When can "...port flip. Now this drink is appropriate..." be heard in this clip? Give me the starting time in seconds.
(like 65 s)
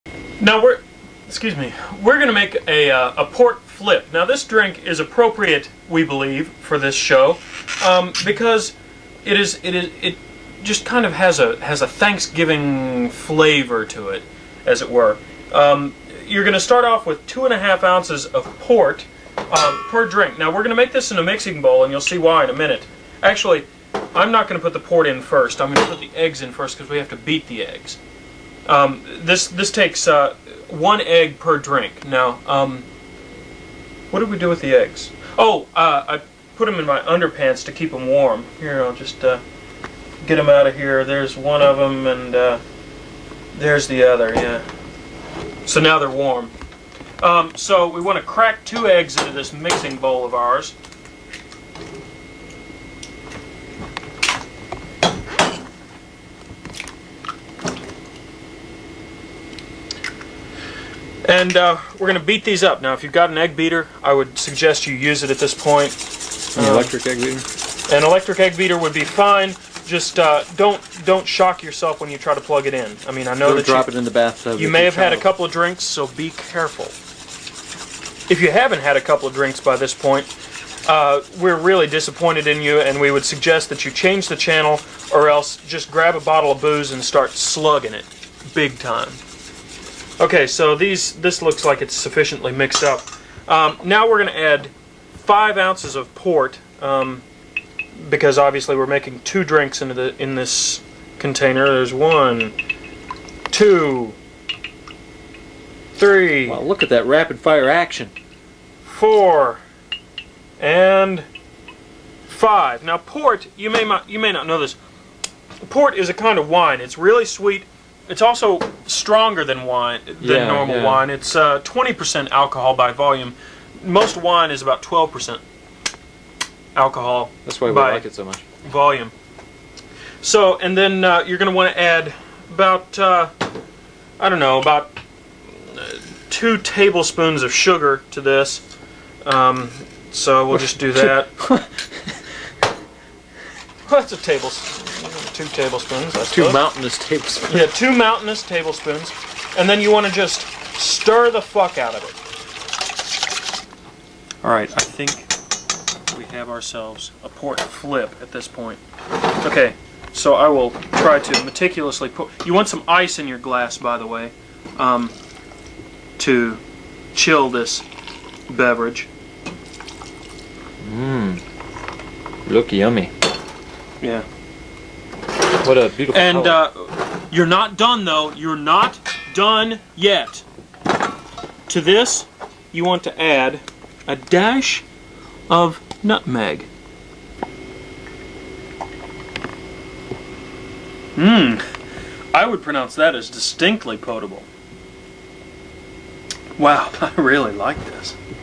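3 s.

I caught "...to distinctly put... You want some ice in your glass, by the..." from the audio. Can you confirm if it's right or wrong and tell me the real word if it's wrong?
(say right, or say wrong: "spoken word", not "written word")
wrong: "meticulously", not "distinctly".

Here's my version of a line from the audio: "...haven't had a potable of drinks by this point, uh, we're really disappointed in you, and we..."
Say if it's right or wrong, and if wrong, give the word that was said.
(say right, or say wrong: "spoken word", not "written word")
wrong: "couple", not "potable".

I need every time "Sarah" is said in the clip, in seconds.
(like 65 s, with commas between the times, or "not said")
not said.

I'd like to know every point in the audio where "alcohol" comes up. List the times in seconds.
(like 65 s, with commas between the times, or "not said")
122 s, 126 s.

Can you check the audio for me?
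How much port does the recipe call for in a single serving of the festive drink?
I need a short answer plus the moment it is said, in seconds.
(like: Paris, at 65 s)
2.5 ounces, at 17 s.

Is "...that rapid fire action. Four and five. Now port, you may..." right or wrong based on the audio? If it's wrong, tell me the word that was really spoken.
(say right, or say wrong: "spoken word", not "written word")
right.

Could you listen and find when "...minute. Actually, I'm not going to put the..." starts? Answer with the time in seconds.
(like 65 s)
22 s.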